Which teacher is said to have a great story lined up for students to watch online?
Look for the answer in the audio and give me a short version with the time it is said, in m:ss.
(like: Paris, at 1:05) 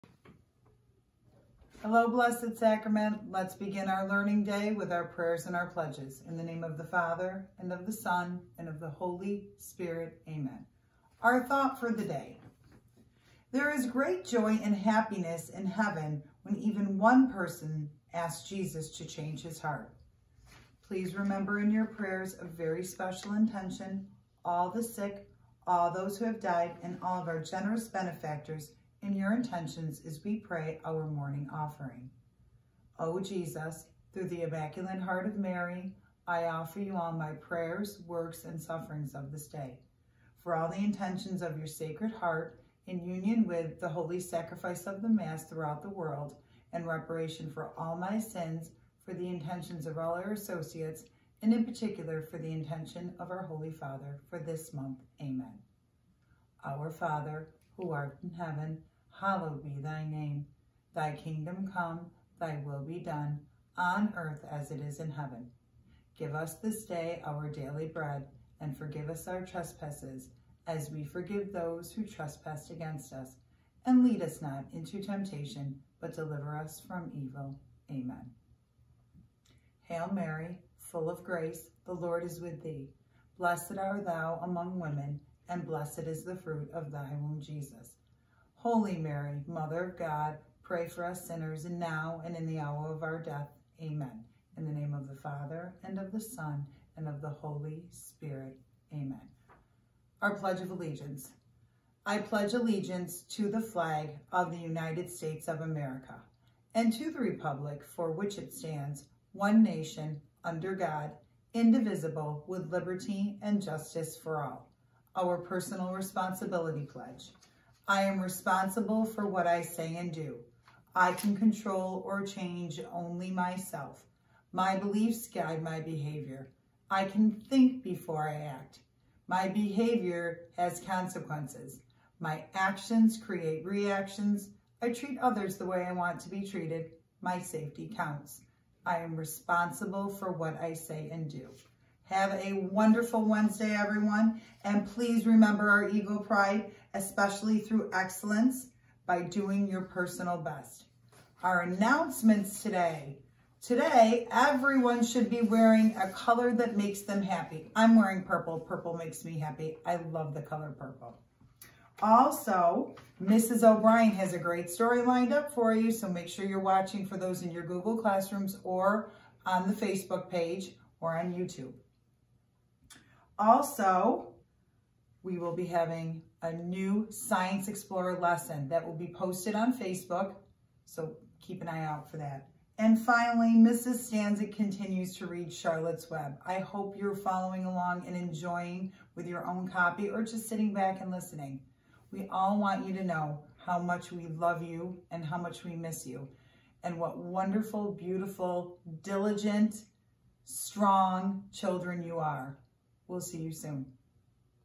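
Mrs. O'Brien, at 2:43.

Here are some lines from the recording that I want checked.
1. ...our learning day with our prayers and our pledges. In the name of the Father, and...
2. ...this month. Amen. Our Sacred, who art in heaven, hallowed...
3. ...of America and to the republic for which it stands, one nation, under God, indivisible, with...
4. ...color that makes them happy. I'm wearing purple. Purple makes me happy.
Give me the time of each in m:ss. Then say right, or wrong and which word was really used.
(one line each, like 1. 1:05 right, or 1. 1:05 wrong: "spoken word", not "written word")
1. 0:03 right
2. 0:54 wrong: "Father", not "Sacred"
3. 1:45 right
4. 2:36 right.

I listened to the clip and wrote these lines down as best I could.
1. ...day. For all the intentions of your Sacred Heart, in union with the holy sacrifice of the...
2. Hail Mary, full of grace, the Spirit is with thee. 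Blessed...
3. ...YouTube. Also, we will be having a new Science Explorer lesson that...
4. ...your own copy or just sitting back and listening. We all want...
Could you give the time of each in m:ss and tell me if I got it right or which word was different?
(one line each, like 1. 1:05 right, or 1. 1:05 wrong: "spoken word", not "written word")
1. 0:39 right
2. 1:19 wrong: "Lord", not "Spirit"
3. 2:51 right
4. 3:09 right.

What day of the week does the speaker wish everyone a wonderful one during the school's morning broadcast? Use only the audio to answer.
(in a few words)
Wednesday.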